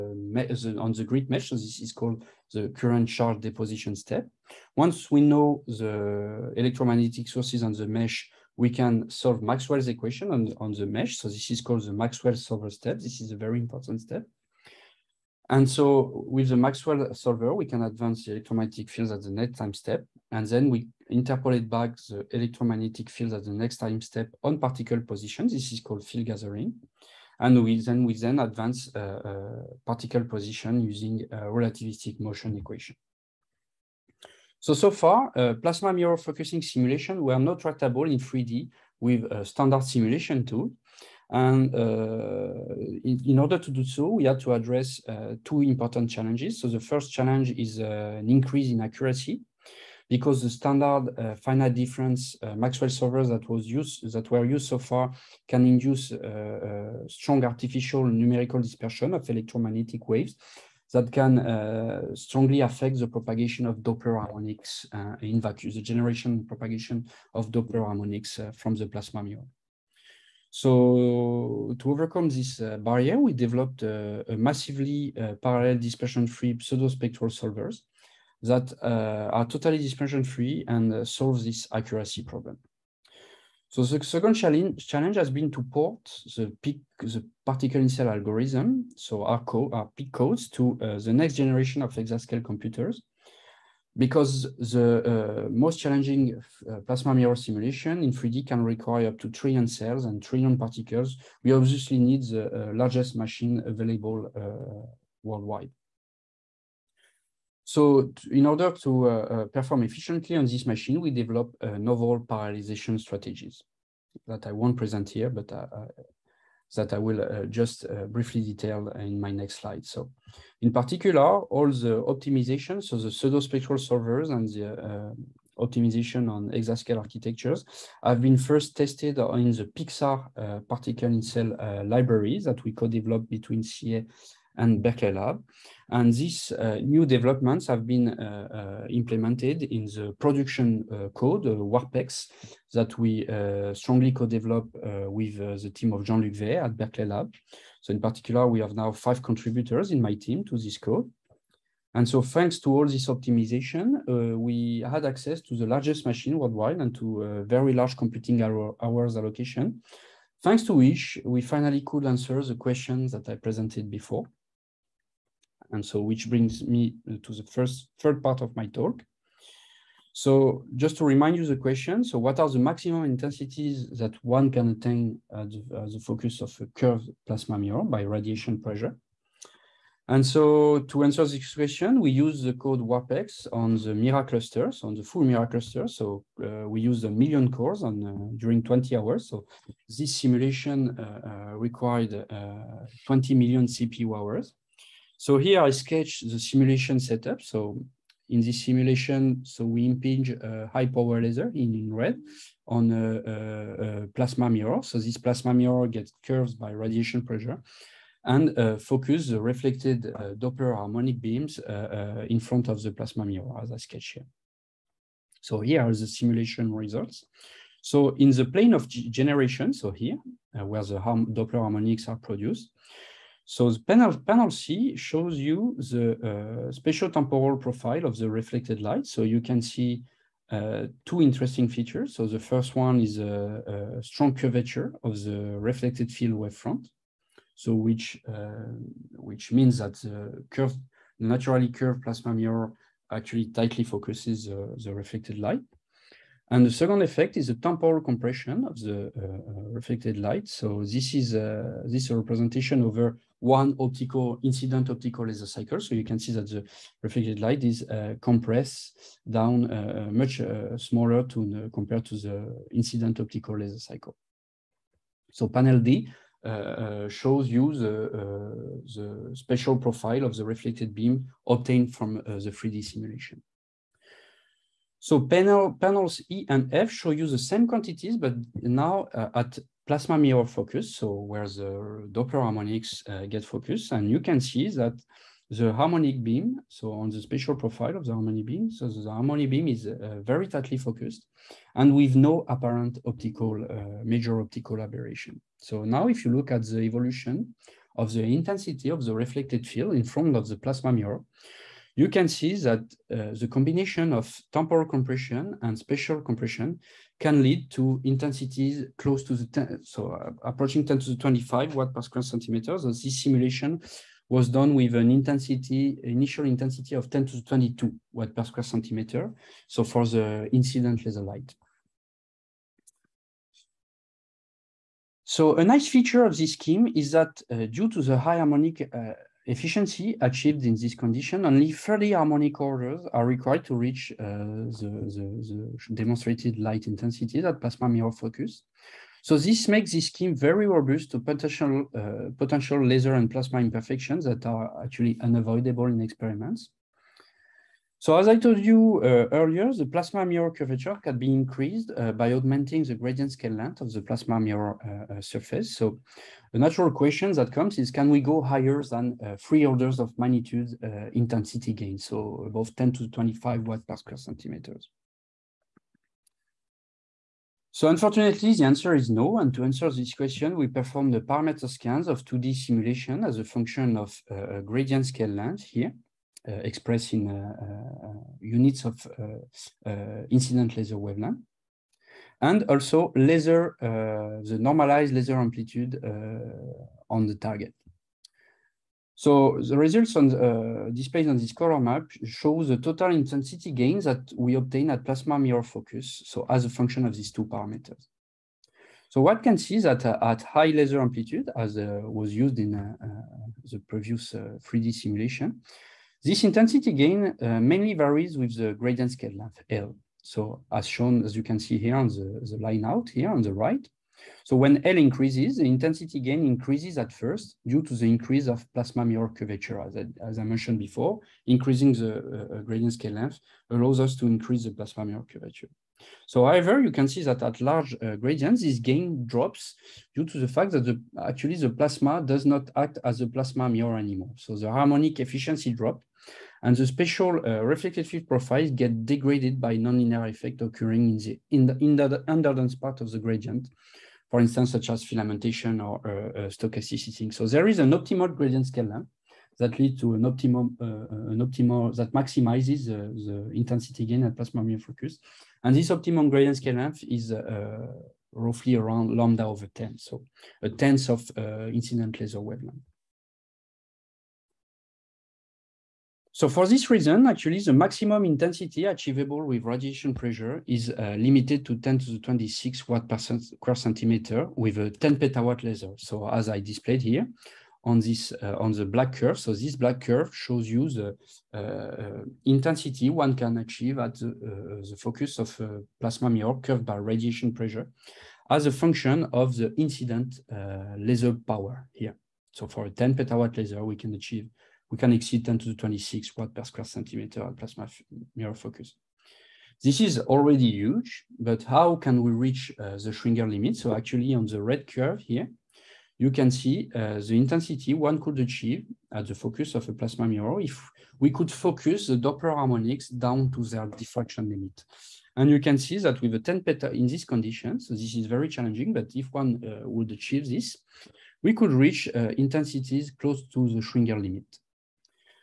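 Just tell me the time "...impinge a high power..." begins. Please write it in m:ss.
3:19.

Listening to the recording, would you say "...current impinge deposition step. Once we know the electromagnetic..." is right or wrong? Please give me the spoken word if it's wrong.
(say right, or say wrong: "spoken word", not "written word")
wrong: "charge", not "impinge".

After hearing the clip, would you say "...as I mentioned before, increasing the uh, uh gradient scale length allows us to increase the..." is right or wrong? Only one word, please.
right.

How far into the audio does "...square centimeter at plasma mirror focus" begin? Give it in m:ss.
8:16.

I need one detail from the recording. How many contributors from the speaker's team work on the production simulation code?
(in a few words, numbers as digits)
5.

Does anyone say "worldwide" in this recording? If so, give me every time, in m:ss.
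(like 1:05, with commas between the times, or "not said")
1:45, 2:36.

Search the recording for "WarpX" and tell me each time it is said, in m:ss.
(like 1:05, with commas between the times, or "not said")
2:21, 3:02.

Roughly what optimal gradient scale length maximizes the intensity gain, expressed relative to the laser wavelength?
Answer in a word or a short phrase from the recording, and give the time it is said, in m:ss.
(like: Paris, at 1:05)
lambda over 10, at 7:39.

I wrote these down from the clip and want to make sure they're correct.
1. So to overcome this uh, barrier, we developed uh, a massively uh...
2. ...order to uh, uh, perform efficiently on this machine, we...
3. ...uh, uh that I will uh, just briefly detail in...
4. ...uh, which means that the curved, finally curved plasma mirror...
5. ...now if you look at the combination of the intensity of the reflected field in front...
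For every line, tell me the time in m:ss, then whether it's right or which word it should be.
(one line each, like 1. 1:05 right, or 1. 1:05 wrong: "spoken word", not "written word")
1. 1:10 right
2. 1:48 right
3. 1:55 right
4. 3:58 wrong: "naturally", not "finally"
5. 4:55 wrong: "evolution", not "combination".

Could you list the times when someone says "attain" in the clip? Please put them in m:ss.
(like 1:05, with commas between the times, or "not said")
2:54.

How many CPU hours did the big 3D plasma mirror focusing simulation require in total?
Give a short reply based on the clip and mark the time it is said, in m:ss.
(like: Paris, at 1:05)
20 million, at 3:13.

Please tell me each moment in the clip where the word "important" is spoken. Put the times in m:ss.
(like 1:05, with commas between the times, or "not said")
0:13, 0:45.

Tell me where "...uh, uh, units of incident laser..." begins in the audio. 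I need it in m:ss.
6:17.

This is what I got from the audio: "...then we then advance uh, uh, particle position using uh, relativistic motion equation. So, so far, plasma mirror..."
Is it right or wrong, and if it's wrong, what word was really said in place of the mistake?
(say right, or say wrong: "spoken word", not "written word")
right.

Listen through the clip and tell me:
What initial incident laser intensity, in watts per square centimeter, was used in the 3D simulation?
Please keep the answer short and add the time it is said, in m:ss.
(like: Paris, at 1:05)
10^22 W/cm², at 5:17.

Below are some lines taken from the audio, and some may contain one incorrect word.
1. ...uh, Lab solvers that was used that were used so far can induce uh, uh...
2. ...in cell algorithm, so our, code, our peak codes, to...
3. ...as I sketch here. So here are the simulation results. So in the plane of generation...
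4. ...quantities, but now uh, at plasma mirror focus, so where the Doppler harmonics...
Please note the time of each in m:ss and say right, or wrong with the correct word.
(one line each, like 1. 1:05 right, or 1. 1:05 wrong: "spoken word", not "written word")
1. 0:52 wrong: "Maxwell", not "Lab"
2. 1:27 right
3. 3:33 right
4. 4:37 right.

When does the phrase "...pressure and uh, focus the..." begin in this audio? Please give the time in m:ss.
3:27.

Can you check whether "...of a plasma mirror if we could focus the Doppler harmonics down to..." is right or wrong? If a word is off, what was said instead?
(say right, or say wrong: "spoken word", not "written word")
right.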